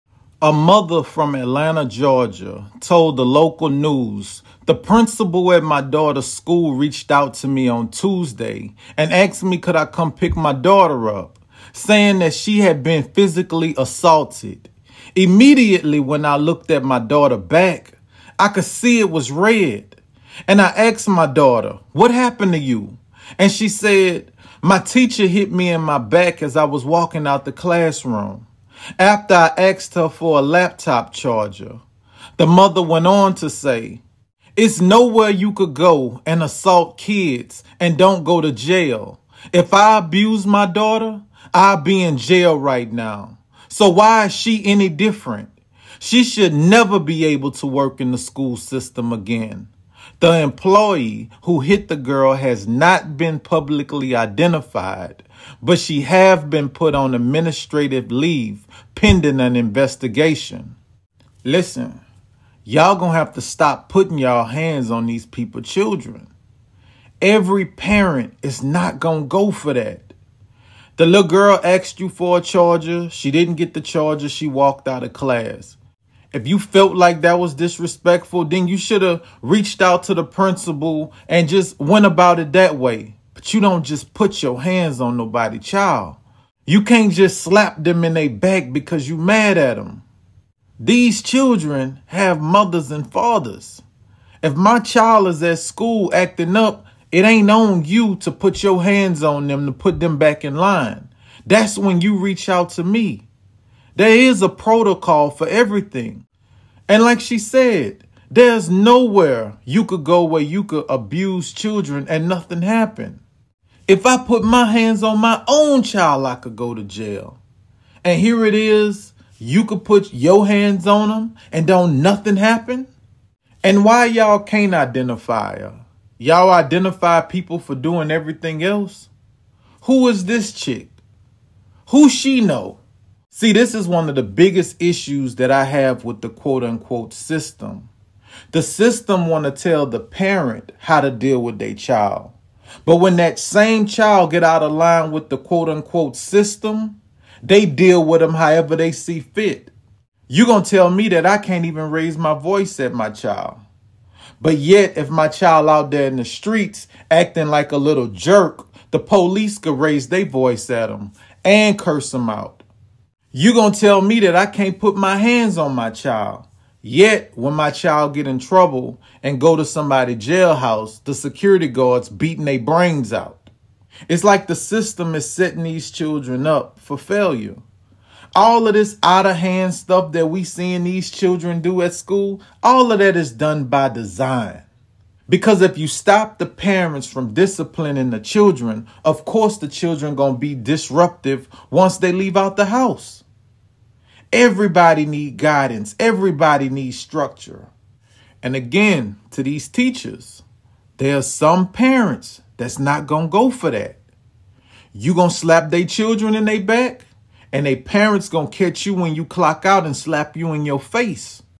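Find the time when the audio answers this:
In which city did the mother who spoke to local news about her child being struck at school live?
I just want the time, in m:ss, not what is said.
0:01.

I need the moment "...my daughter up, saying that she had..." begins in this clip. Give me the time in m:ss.
0:10.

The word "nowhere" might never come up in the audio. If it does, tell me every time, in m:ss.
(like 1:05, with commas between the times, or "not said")
0:34, 1:48.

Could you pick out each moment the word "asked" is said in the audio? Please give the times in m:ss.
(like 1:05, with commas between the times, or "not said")
0:09, 0:20, 0:29, 1:11.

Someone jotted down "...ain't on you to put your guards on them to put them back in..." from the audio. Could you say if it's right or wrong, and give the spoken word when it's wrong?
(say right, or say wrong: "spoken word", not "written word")
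wrong: "hands", not "guards".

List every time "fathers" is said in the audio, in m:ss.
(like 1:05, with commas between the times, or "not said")
1:33.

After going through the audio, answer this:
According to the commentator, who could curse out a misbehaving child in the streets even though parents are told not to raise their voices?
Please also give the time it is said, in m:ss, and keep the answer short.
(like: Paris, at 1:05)
The police, at 2:38.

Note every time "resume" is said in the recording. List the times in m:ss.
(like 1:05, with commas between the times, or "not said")
not said.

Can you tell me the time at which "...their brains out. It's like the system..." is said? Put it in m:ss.
2:52.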